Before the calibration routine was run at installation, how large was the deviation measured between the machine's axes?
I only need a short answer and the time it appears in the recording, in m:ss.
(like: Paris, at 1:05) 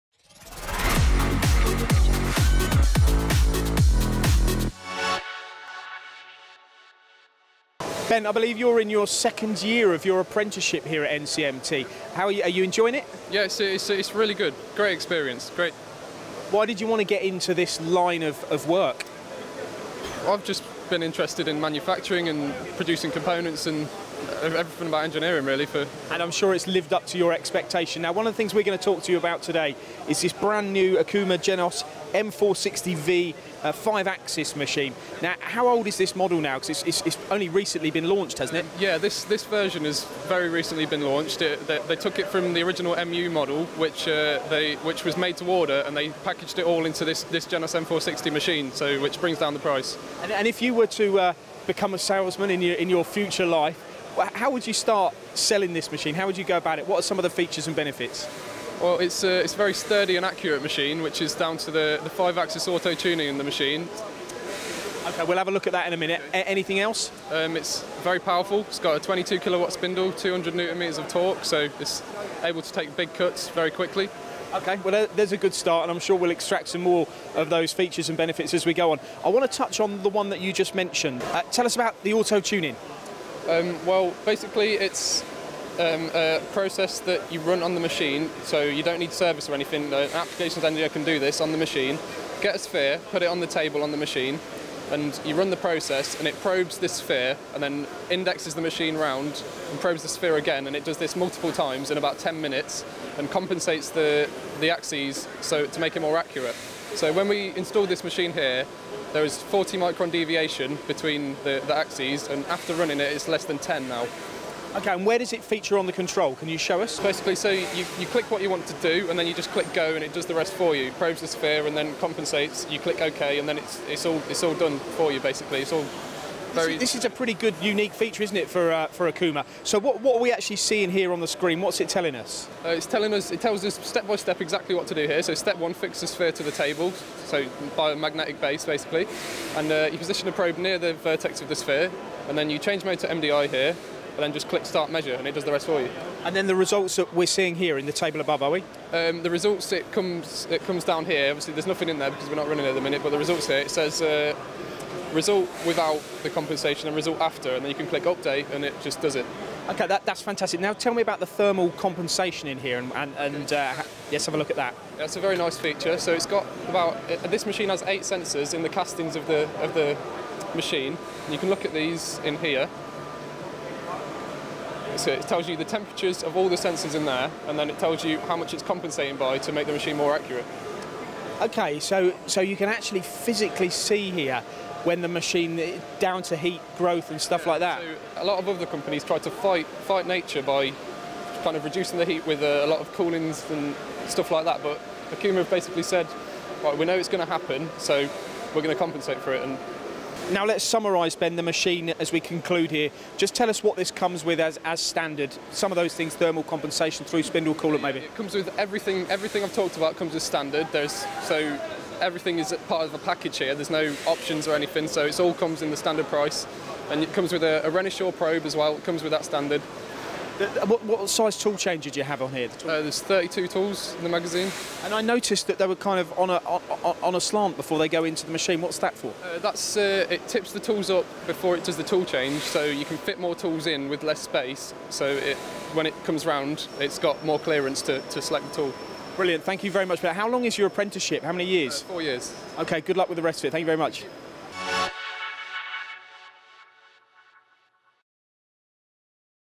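40 microns, at 1:49.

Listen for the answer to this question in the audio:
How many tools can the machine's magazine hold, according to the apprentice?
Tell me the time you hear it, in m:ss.
3:42.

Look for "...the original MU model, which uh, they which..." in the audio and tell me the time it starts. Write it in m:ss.
0:42.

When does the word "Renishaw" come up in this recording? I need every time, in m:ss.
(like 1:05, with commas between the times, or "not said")
3:37.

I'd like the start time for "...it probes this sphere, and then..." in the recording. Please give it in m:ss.
1:36.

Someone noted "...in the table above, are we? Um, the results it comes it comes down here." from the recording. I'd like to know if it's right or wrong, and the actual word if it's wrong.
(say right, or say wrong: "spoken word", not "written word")
right.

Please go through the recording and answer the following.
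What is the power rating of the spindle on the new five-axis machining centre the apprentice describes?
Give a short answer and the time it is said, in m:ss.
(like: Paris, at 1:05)
22 kilowatts, at 1:08.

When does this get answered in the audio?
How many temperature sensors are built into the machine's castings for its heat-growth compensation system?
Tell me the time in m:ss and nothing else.
2:47.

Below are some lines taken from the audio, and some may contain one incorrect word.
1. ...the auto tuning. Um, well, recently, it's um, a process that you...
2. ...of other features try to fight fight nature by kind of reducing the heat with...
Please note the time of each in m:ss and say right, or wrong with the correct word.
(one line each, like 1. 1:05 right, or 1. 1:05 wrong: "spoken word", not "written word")
1. 1:22 wrong: "basically", not "recently"
2. 3:08 wrong: "companies", not "features".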